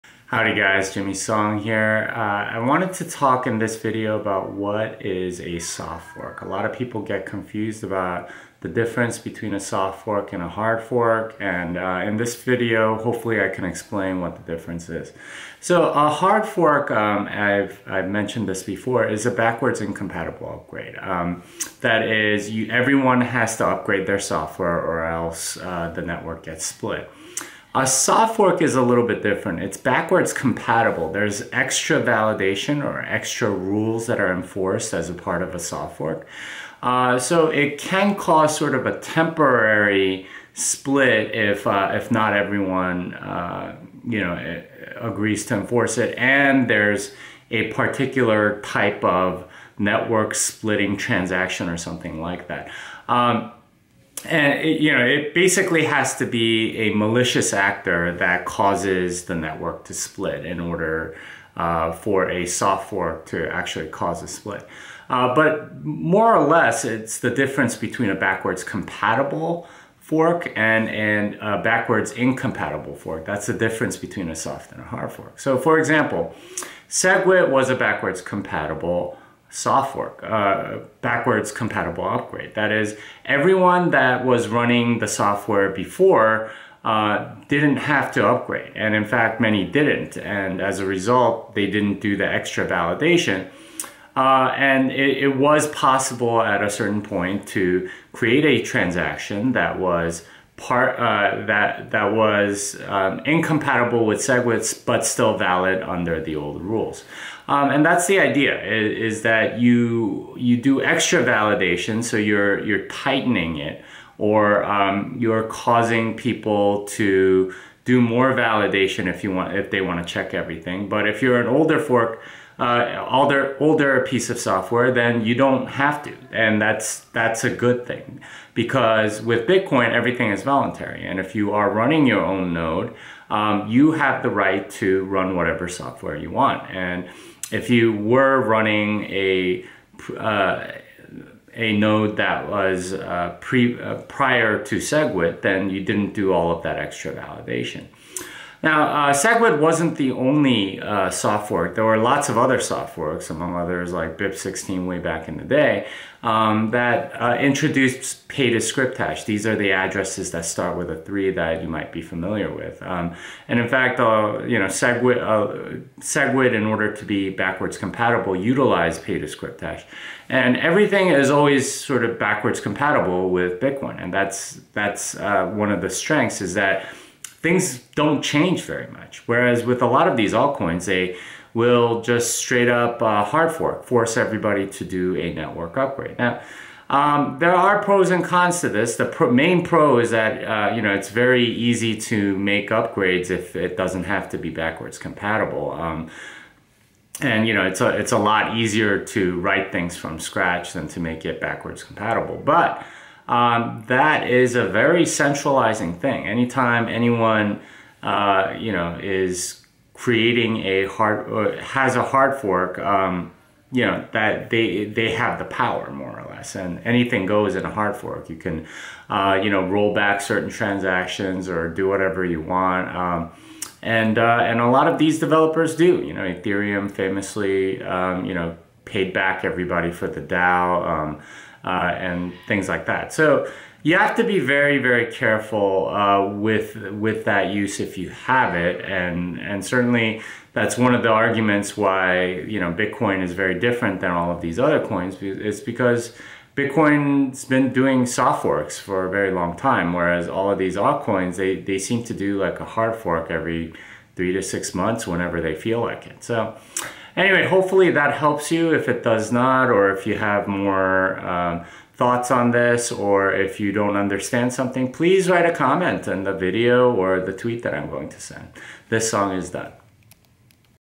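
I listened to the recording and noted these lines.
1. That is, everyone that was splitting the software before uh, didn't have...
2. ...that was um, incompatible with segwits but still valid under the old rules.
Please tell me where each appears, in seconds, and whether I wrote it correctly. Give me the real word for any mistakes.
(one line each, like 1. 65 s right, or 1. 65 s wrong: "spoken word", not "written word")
1. 82 s wrong: "running", not "splitting"
2. 101 s right.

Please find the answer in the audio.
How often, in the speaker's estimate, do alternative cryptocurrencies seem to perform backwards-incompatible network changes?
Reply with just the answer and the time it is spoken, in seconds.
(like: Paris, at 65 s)
every 3 to 6 months, at 253 s.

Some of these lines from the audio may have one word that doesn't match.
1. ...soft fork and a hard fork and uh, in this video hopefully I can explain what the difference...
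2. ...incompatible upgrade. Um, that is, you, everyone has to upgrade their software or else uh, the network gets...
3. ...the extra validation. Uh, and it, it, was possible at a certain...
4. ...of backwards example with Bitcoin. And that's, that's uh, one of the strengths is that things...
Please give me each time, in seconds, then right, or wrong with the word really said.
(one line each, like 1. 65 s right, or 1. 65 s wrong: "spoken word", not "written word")
1. 9 s right
2. 19 s right
3. 92 s right
4. 172 s wrong: "compatible", not "example".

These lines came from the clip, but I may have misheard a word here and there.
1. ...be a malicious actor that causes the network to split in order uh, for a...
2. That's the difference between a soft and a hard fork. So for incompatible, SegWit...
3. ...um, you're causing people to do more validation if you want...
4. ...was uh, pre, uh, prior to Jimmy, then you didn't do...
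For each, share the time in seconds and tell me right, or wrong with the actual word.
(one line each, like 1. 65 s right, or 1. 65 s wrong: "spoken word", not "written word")
1. 56 s right
2. 73 s wrong: "example", not "incompatible"
3. 114 s right
4. 142 s wrong: "SegWit", not "Jimmy".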